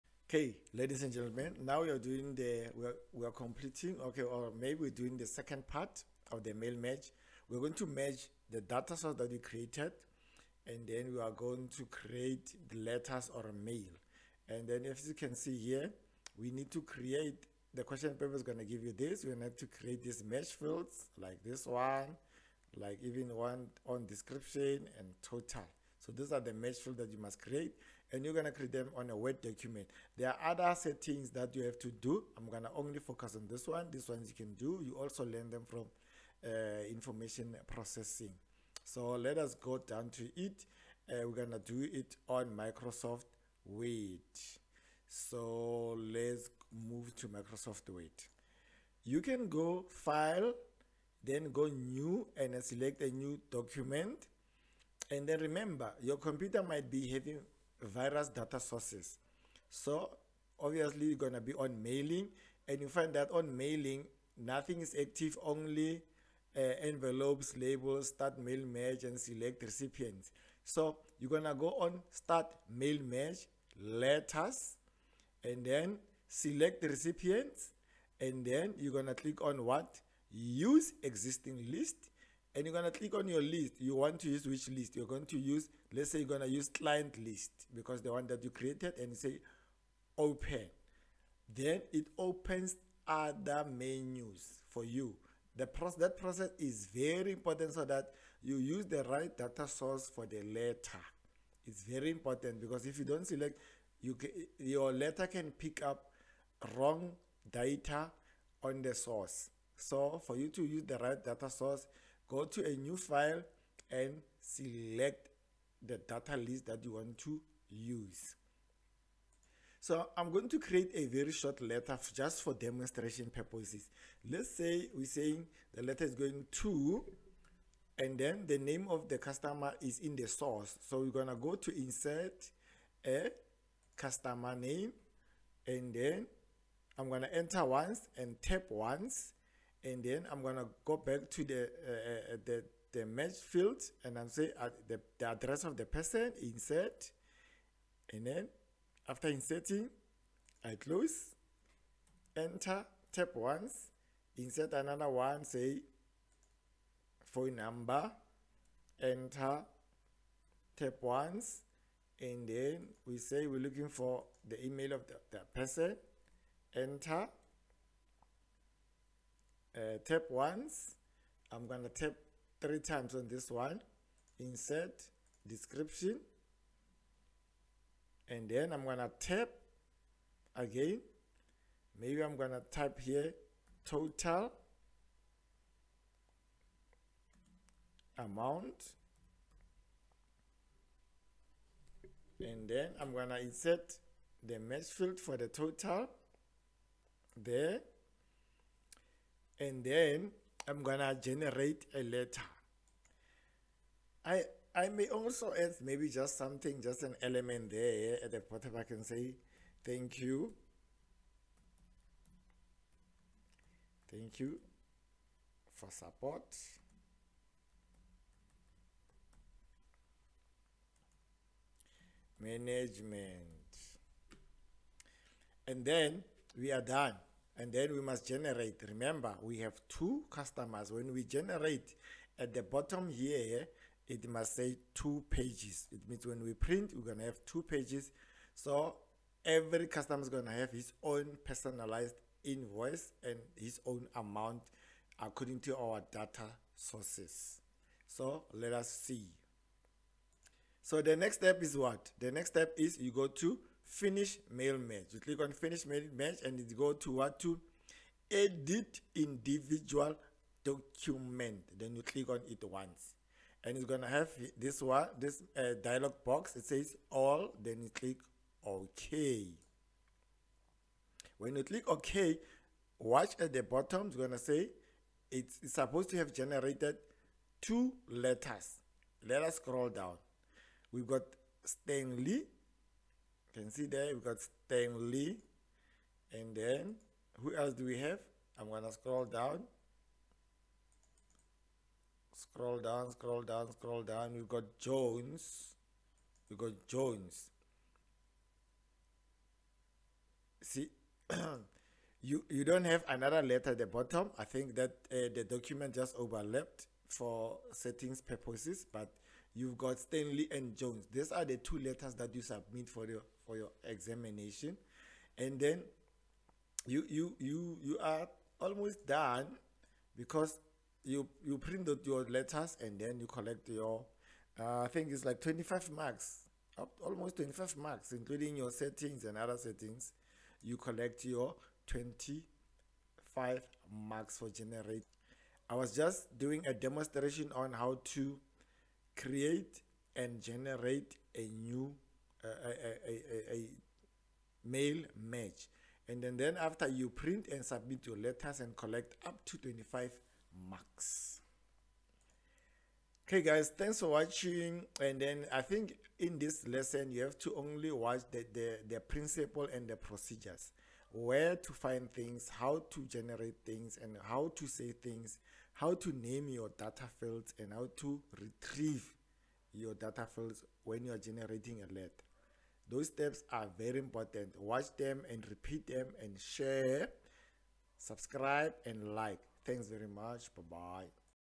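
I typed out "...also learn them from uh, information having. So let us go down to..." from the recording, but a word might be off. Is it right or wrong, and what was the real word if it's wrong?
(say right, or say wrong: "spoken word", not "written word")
wrong: "processing", not "having".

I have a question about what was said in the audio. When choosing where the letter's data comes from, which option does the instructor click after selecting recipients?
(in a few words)
Use existing list.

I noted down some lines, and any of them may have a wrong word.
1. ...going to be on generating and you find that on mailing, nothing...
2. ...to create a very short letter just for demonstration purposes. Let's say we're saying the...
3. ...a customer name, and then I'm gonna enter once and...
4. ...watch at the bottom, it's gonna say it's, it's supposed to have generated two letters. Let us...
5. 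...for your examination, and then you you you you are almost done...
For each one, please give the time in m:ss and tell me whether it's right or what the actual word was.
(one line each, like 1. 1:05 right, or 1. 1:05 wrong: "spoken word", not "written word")
1. 1:01 wrong: "mailing", not "generating"
2. 2:00 right
3. 2:13 right
4. 4:32 right
5. 5:13 right.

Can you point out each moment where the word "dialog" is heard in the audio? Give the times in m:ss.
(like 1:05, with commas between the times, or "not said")
4:25.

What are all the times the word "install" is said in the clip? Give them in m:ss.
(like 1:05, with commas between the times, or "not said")
not said.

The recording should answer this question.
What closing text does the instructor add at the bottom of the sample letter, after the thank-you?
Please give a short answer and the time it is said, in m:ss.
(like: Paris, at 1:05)
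Thank you for support. Management, at 3:34.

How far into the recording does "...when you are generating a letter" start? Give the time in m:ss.
6:10.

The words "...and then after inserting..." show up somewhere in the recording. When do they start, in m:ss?
2:28.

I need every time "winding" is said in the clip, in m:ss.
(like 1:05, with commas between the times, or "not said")
not said.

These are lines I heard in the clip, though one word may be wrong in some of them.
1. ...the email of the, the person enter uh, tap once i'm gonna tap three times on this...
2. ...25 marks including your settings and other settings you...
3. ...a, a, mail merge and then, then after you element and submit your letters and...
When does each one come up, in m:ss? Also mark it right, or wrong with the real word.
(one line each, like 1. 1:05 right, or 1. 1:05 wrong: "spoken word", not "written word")
1. 2:44 right
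2. 5:27 right
3. 5:43 wrong: "print", not "element".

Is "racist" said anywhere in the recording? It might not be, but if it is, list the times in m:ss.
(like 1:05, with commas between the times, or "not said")
not said.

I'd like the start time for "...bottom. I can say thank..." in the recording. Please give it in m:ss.
3:28.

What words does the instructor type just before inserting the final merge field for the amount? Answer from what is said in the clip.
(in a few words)
Total amount.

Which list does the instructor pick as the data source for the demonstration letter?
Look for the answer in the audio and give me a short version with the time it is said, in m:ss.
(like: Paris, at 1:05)
Client list, at 1:26.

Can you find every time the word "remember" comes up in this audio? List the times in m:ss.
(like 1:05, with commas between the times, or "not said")
0:55, 3:48.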